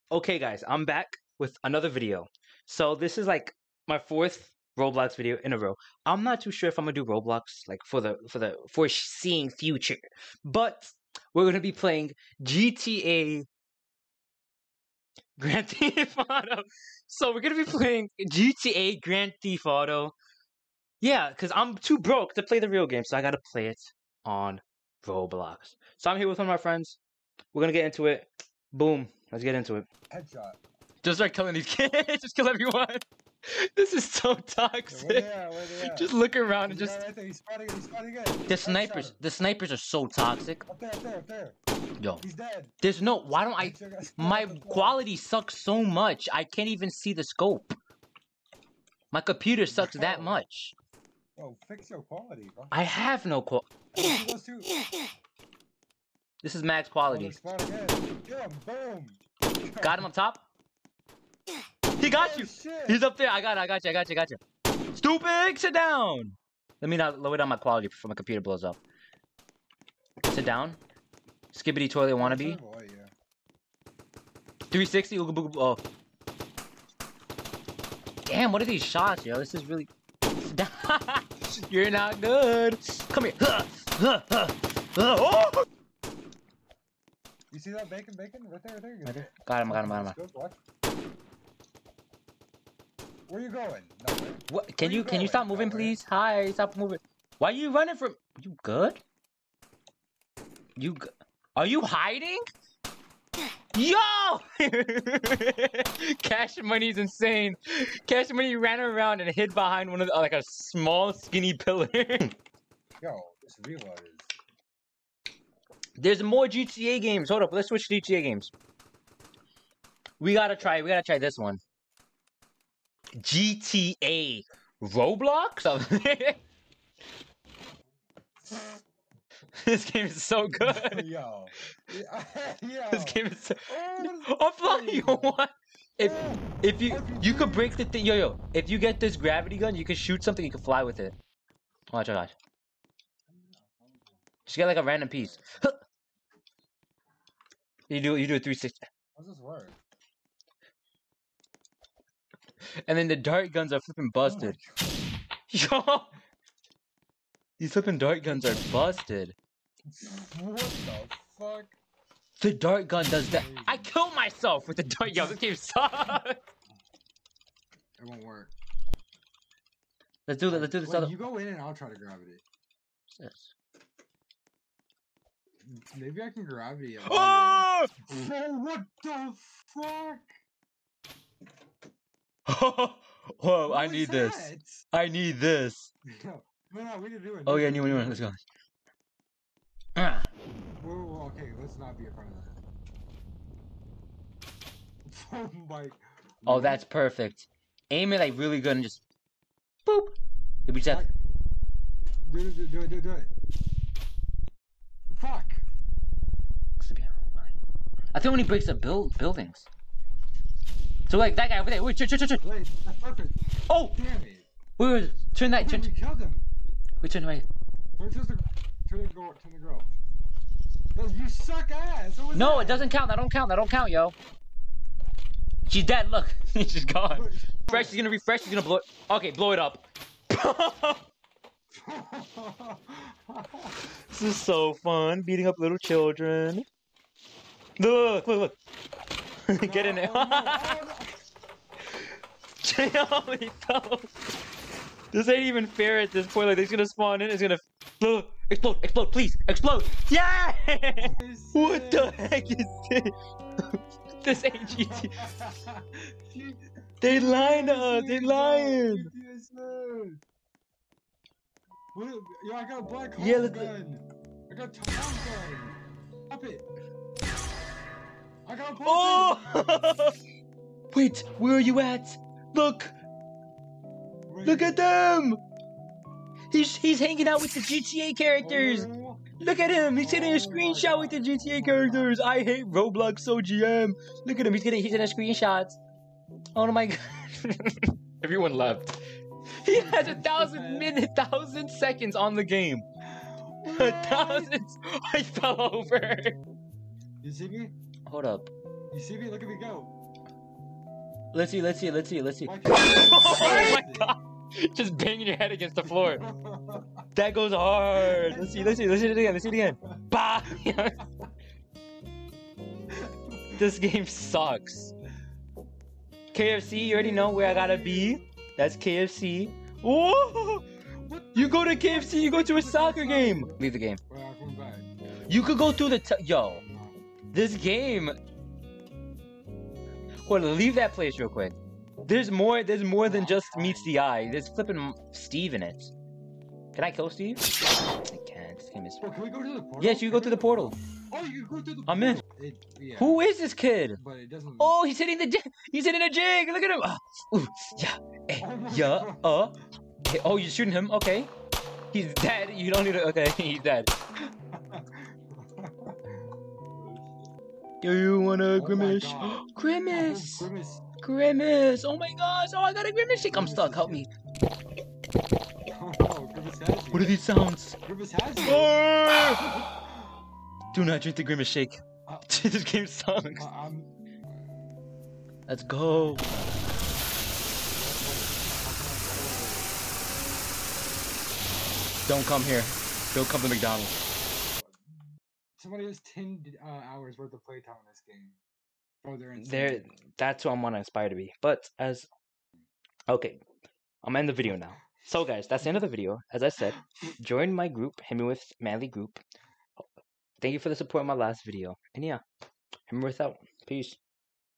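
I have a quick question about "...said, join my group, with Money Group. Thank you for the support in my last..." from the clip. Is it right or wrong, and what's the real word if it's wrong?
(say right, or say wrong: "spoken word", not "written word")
wrong: "Manly", not "Money".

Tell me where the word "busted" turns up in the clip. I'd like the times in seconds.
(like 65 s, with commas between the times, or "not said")
154 s, 158 s.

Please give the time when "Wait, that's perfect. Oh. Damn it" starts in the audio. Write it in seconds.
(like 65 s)
212 s.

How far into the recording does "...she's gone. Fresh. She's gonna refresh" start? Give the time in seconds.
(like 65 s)
226 s.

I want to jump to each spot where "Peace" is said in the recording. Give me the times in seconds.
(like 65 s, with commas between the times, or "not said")
403 s.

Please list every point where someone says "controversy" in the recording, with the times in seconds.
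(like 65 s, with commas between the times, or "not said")
not said.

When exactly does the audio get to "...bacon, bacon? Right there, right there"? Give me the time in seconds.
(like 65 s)
87 s.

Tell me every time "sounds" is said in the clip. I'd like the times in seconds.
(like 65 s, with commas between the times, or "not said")
367 s.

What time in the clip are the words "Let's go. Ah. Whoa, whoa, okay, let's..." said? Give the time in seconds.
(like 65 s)
188 s.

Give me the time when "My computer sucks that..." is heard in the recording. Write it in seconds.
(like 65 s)
49 s.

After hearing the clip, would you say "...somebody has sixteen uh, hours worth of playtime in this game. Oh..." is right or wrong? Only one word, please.
wrong.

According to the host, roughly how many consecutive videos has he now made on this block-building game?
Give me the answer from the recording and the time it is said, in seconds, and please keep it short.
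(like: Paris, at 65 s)
4, at 3 s.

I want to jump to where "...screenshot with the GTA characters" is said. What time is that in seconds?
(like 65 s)
280 s.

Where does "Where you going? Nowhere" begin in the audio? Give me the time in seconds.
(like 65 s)
93 s.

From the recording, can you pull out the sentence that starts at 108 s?
Cash Money ran around and hid behind one of the, like a small skinny pillar.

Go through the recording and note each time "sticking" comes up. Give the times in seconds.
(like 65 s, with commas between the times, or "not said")
not said.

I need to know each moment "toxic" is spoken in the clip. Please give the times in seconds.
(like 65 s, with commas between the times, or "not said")
34 s, 40 s.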